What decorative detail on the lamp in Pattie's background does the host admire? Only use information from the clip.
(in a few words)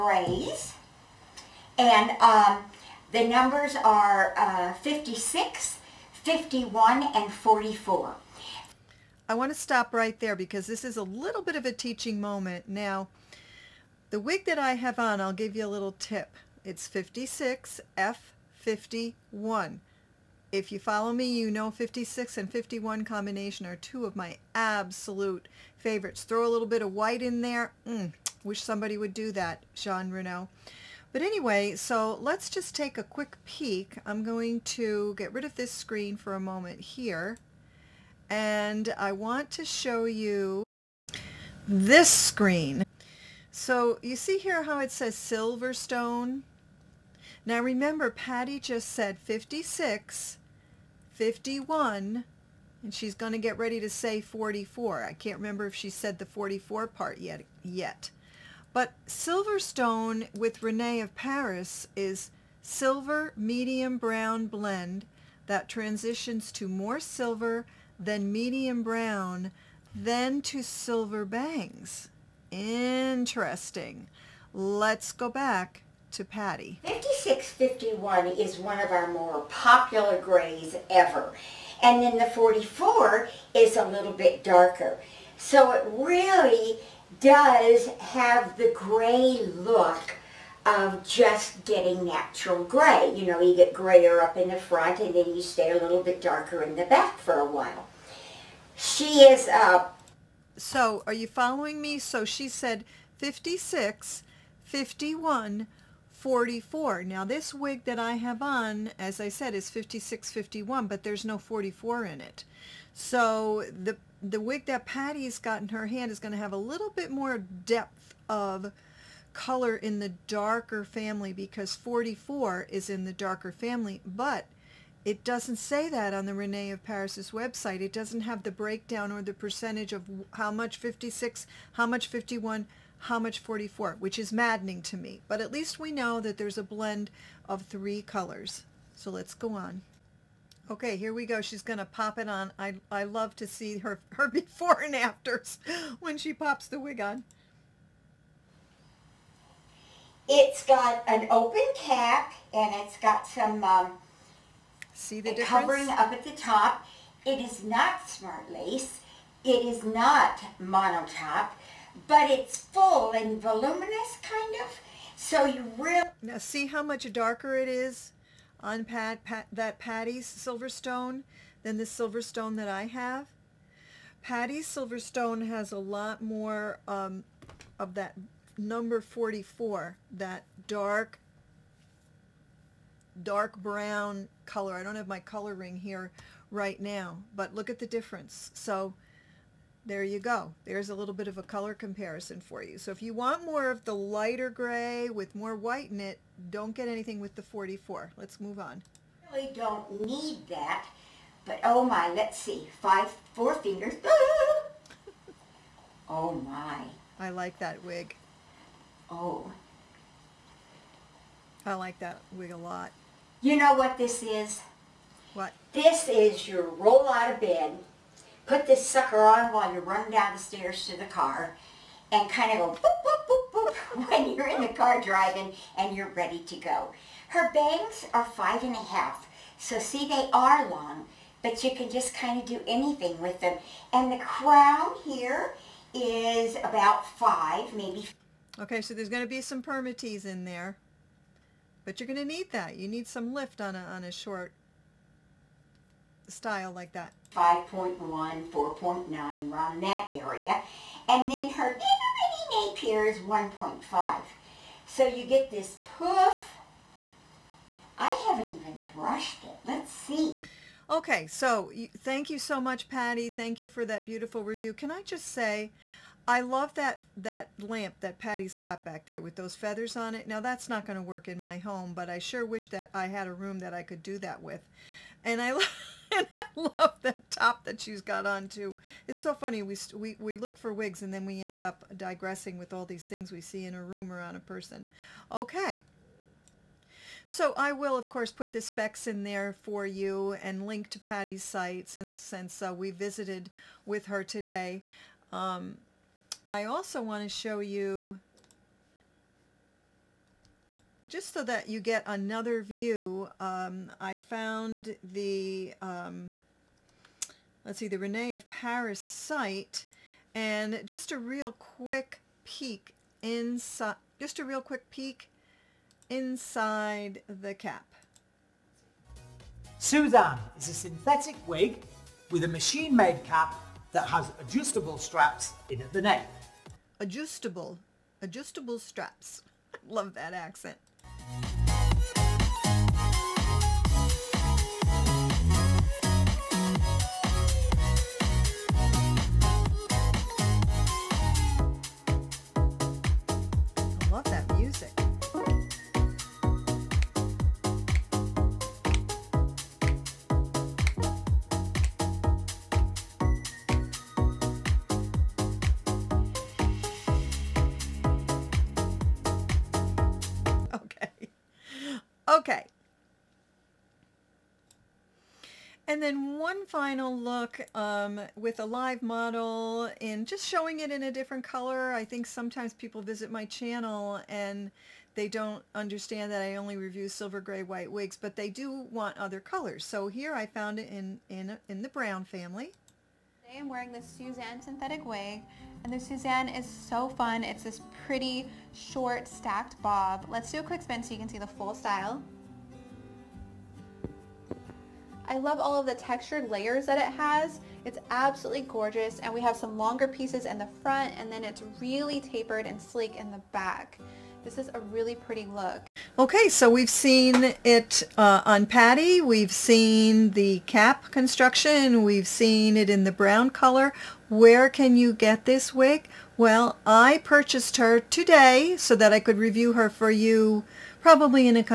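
feathers.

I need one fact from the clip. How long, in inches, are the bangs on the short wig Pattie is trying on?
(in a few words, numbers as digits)
5 and a half.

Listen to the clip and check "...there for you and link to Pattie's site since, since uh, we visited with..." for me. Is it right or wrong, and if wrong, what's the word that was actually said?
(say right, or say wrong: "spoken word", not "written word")
right.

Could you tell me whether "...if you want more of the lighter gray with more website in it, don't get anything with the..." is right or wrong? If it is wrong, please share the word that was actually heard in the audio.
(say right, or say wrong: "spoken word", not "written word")
wrong: "white", not "website".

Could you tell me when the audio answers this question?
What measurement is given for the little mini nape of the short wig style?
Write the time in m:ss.
4:13.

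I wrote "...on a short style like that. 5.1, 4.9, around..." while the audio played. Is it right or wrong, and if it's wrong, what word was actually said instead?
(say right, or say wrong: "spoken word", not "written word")
right.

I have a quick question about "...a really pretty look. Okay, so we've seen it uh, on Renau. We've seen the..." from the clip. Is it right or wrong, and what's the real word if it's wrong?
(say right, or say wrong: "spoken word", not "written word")
wrong: "Pattie", not "Renau".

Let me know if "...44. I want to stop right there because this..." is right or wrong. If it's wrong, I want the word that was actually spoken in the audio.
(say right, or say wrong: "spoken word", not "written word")
right.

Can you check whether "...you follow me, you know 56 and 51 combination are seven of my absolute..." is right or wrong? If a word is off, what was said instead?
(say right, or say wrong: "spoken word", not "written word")
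wrong: "two", not "seven".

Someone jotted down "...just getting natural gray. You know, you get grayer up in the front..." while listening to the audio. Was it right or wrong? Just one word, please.
right.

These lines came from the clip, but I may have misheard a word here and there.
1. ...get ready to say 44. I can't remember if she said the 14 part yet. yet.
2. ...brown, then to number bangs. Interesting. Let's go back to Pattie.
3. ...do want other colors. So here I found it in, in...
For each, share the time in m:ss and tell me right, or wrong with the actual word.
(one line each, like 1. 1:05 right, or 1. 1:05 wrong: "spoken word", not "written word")
1. 0:53 wrong: "44", not "14"
2. 1:08 wrong: "silver", not "number"
3. 6:18 right.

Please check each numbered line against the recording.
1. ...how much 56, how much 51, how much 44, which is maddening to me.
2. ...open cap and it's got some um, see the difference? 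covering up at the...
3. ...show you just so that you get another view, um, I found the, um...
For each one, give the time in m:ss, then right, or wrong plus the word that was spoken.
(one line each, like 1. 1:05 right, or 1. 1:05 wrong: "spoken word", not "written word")
1. 2:10 right
2. 2:31 right
3. 4:57 right.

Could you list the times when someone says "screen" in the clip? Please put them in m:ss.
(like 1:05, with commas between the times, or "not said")
0:35, 0:42.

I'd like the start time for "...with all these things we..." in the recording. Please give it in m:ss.
4:42.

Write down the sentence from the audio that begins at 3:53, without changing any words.
And the crown here is about five, maybe.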